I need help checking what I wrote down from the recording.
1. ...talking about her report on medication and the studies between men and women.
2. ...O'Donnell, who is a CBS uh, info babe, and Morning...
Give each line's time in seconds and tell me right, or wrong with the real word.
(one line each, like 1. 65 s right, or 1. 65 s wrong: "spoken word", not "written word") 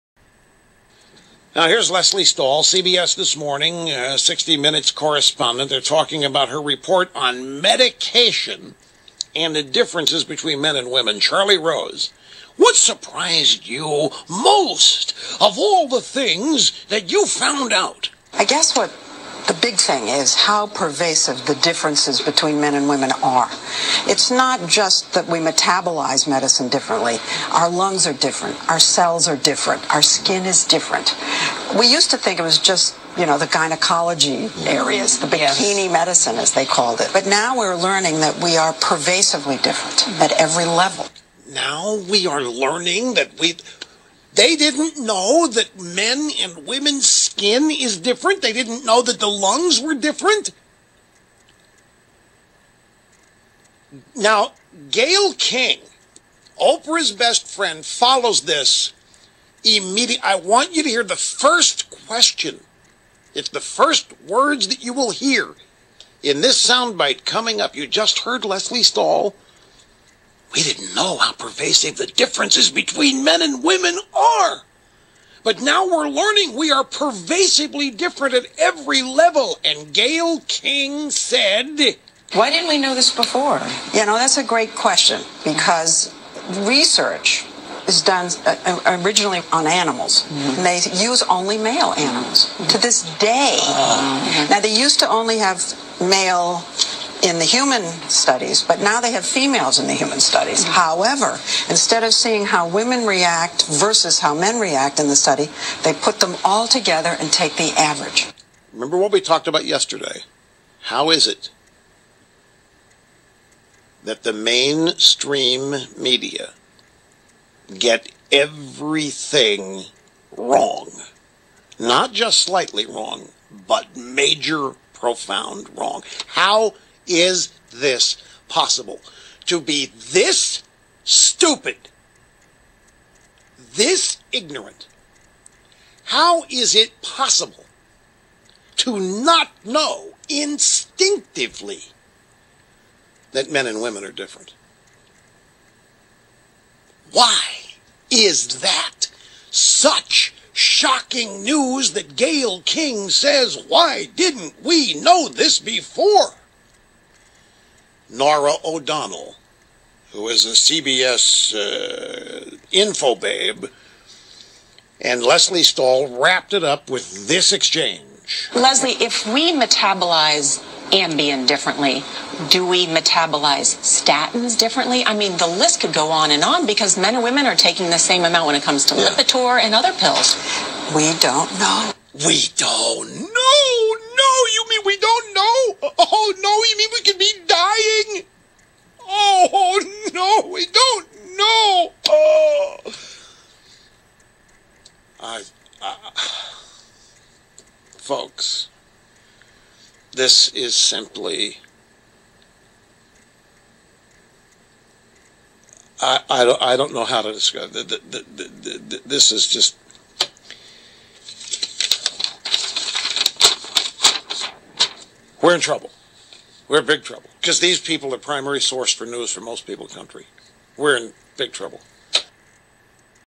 1. 5 s wrong: "differences", not "studies"
2. 158 s wrong: "Leslie", not "Morning".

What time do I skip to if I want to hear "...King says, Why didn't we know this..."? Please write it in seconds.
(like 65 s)
152 s.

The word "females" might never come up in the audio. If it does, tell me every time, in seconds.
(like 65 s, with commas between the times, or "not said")
99 s.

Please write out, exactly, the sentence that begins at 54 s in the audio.
Now, Gayle King, Oprah's best friend, follows this immediately.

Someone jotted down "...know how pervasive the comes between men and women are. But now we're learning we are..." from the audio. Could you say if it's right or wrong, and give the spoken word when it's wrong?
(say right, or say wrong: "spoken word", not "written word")
wrong: "differences", not "comes".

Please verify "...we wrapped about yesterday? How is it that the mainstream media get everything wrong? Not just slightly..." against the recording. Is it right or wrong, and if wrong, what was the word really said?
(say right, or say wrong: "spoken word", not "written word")
wrong: "talked", not "wrapped".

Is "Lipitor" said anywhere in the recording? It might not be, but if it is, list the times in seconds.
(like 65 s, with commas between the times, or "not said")
179 s.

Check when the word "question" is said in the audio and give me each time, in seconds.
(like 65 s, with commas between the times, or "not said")
62 s, 84 s.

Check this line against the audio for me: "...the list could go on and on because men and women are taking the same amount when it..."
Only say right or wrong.
right.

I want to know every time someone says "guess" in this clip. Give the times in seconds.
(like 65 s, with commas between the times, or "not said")
18 s.